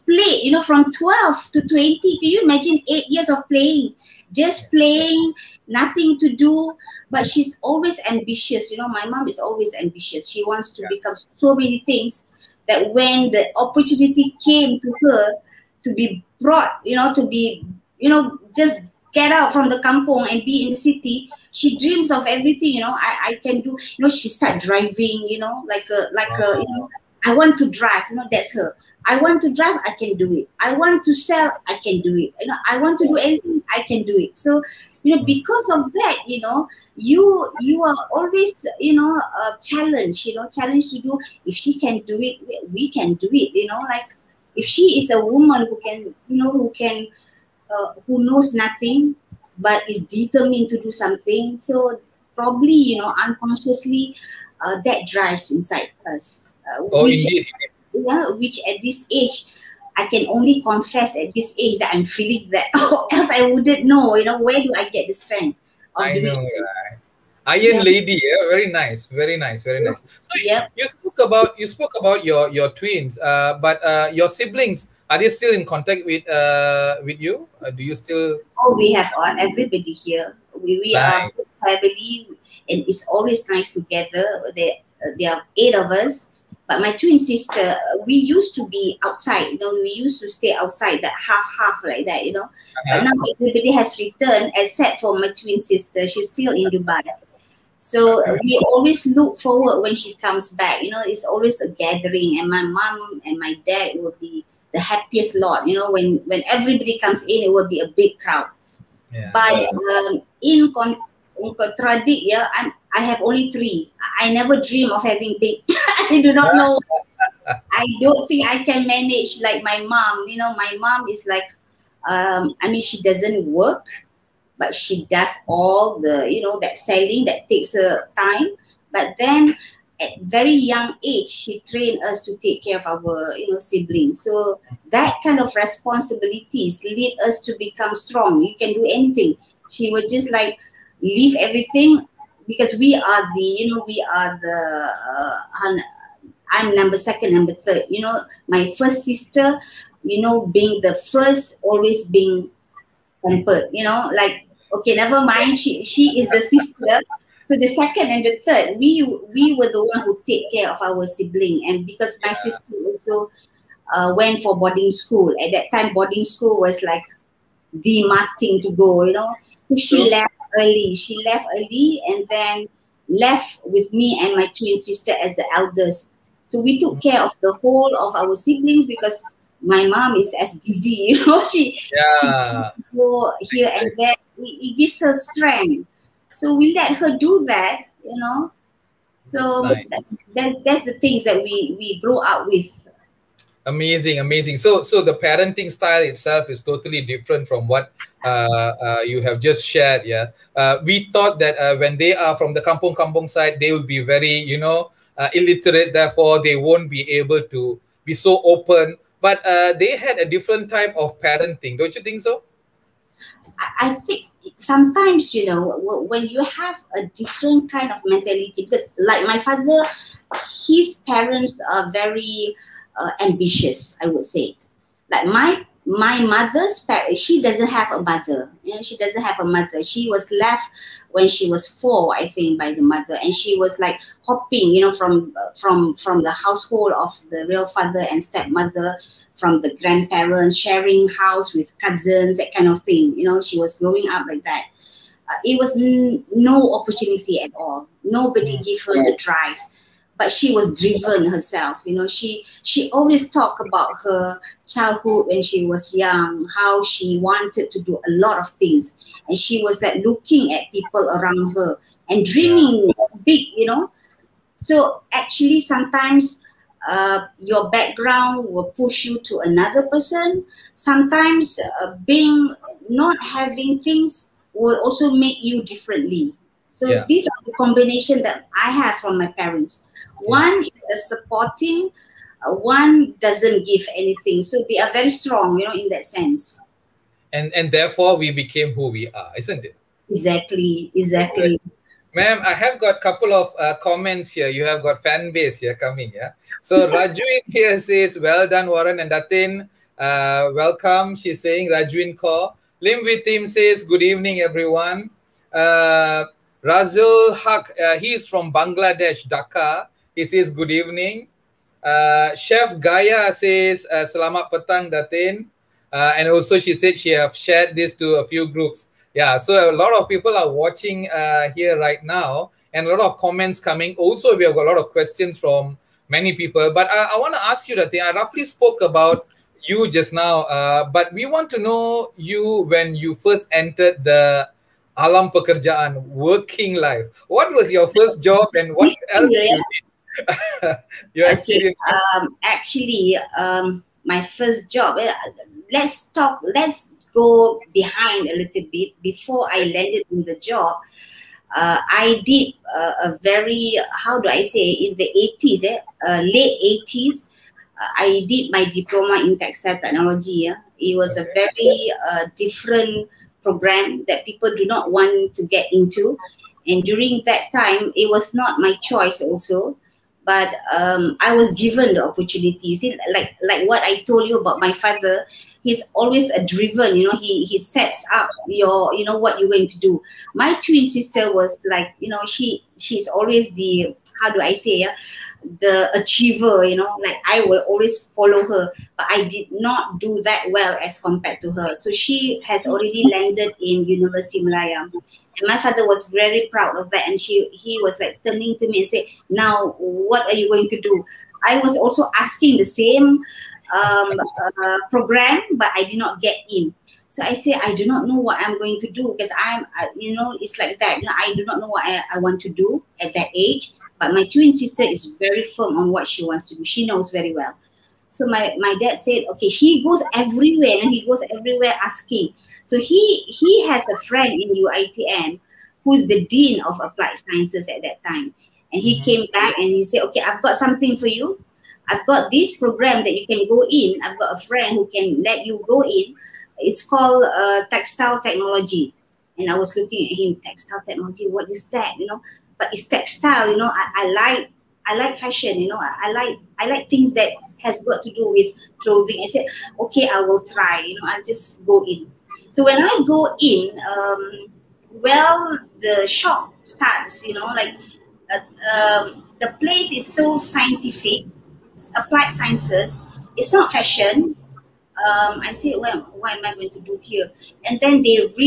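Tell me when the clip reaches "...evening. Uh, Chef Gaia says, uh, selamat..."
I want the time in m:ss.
5:10.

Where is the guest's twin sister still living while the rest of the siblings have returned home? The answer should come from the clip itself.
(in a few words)
Dubai.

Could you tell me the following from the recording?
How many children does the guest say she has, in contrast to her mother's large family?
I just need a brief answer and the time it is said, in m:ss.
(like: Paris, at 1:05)
3, at 1:53.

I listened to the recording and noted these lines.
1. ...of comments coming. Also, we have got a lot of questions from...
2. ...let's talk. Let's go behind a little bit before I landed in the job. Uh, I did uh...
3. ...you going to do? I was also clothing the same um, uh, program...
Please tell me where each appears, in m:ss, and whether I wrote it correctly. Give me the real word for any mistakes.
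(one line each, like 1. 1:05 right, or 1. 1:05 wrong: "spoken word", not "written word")
1. 5:23 right
2. 5:45 right
3. 6:40 wrong: "asking", not "clothing".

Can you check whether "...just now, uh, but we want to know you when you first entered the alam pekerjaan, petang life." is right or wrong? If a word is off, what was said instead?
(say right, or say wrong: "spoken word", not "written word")
wrong: "working", not "petang".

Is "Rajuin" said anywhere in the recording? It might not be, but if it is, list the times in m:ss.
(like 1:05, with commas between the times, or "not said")
4:56, 5:01.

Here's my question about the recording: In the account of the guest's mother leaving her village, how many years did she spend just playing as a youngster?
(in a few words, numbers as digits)
8.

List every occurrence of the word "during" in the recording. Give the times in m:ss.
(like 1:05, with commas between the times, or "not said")
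6:06.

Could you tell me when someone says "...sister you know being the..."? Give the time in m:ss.
2:29.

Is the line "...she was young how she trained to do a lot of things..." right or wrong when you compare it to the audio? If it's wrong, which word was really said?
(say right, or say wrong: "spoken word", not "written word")
wrong: "wanted", not "trained".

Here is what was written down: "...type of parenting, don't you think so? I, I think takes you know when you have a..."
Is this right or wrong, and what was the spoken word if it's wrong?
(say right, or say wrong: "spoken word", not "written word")
wrong: "sometimes", not "takes".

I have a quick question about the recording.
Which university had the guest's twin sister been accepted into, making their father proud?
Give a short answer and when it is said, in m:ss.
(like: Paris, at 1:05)
University of Malaya, at 6:33.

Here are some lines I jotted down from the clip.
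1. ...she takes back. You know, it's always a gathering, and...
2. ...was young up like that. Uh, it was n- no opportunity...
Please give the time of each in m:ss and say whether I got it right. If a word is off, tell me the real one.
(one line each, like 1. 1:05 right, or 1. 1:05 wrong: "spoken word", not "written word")
1. 1:39 wrong: "comes", not "takes"
2. 4:03 wrong: "growing", not "young".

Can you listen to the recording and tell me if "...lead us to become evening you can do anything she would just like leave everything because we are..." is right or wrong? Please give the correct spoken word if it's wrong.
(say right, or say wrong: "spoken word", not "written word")
wrong: "strong", not "evening".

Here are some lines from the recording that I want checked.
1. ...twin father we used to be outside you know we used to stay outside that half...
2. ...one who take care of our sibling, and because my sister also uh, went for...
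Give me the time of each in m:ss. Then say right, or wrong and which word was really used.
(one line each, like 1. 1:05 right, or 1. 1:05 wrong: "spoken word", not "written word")
1. 1:26 wrong: "sister", not "father"
2. 2:39 right.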